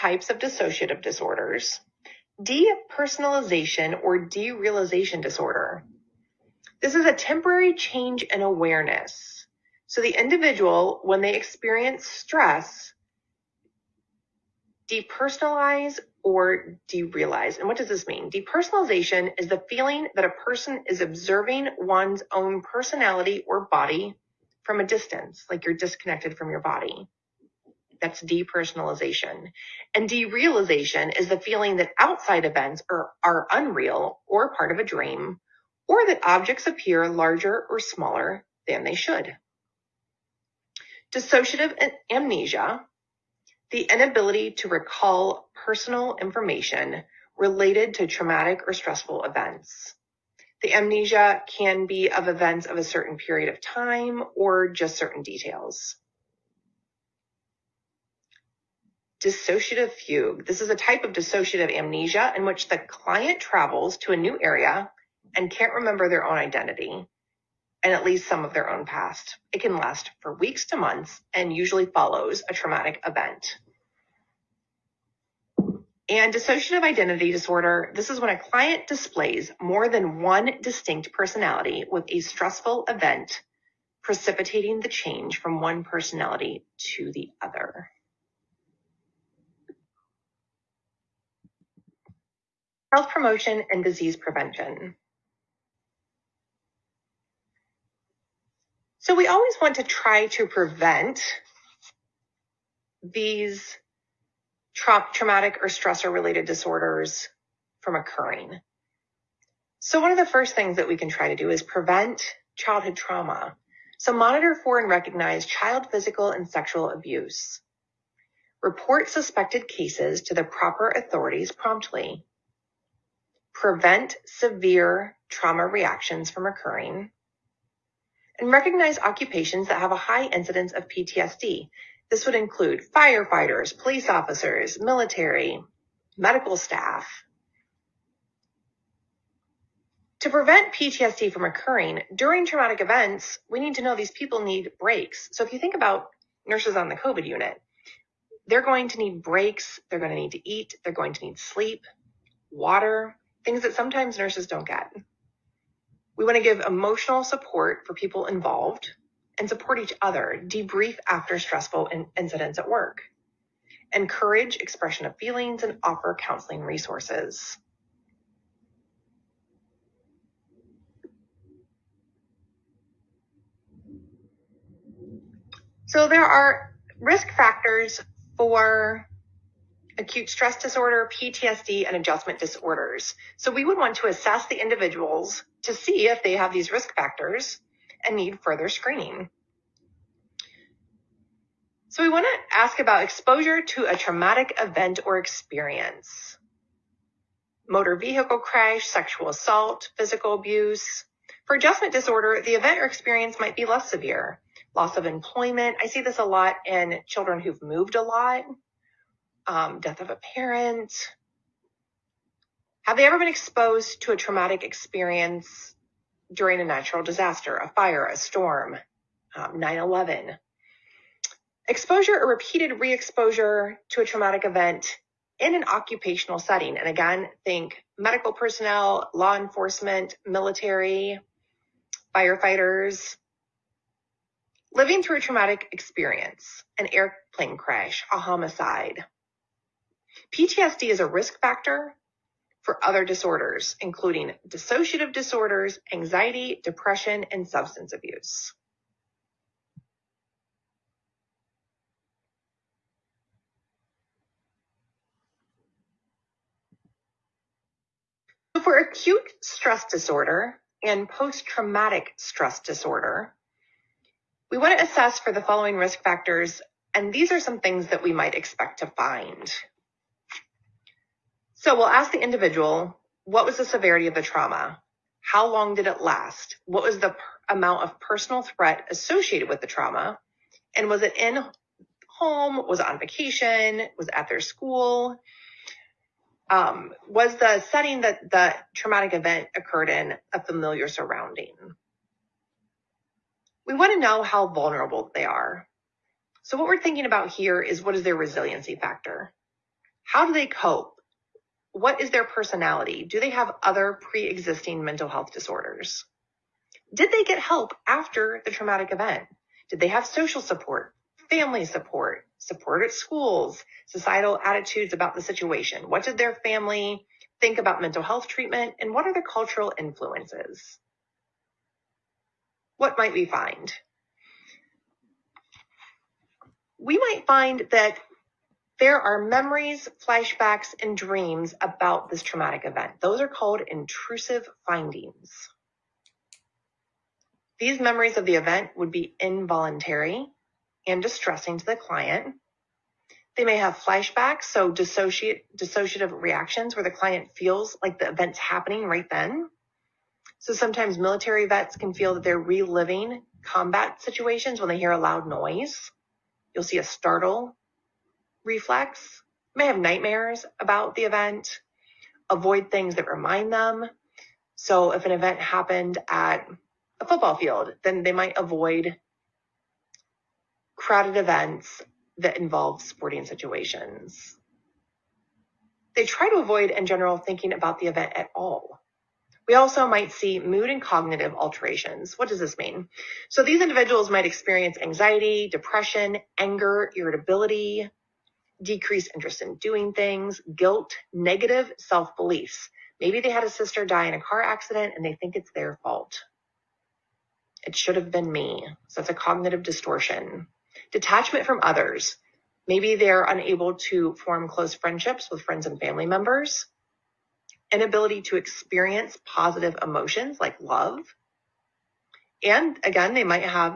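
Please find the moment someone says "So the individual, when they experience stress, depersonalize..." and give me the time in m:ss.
0:09.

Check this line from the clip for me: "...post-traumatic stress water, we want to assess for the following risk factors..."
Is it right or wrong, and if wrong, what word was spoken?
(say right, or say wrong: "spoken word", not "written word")
wrong: "disorder", not "water".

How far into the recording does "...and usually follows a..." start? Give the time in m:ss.
1:11.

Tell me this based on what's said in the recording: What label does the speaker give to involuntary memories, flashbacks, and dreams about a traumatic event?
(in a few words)
Intrusive findings.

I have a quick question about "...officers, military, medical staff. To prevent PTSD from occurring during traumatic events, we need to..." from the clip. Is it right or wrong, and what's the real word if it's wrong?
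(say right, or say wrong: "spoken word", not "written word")
right.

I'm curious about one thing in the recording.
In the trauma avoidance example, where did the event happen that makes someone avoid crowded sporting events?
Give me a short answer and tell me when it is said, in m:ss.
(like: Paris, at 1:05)
A football field, at 6:07.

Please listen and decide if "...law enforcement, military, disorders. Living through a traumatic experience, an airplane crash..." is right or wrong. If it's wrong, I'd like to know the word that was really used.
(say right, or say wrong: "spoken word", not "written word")
wrong: "firefighters", not "disorders".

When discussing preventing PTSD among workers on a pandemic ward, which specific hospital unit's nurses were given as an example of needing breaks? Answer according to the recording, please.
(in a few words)
COVID unit.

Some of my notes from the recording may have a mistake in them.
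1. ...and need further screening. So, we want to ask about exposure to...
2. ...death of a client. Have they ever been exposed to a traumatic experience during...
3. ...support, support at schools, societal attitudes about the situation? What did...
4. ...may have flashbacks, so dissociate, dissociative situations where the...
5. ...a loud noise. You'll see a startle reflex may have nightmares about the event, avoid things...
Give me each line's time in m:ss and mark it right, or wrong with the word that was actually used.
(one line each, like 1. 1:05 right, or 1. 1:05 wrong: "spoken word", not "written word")
1. 3:08 right
2. 3:29 wrong: "parent", not "client"
3. 5:11 right
4. 5:43 wrong: "reactions", not "situations"
5. 5:54 right.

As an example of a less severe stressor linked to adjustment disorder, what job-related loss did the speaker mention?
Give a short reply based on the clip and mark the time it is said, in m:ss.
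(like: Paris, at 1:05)
Loss of employment, at 3:24.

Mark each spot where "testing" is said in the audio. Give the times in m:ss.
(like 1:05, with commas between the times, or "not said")
not said.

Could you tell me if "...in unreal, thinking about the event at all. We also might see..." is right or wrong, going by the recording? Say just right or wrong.
wrong.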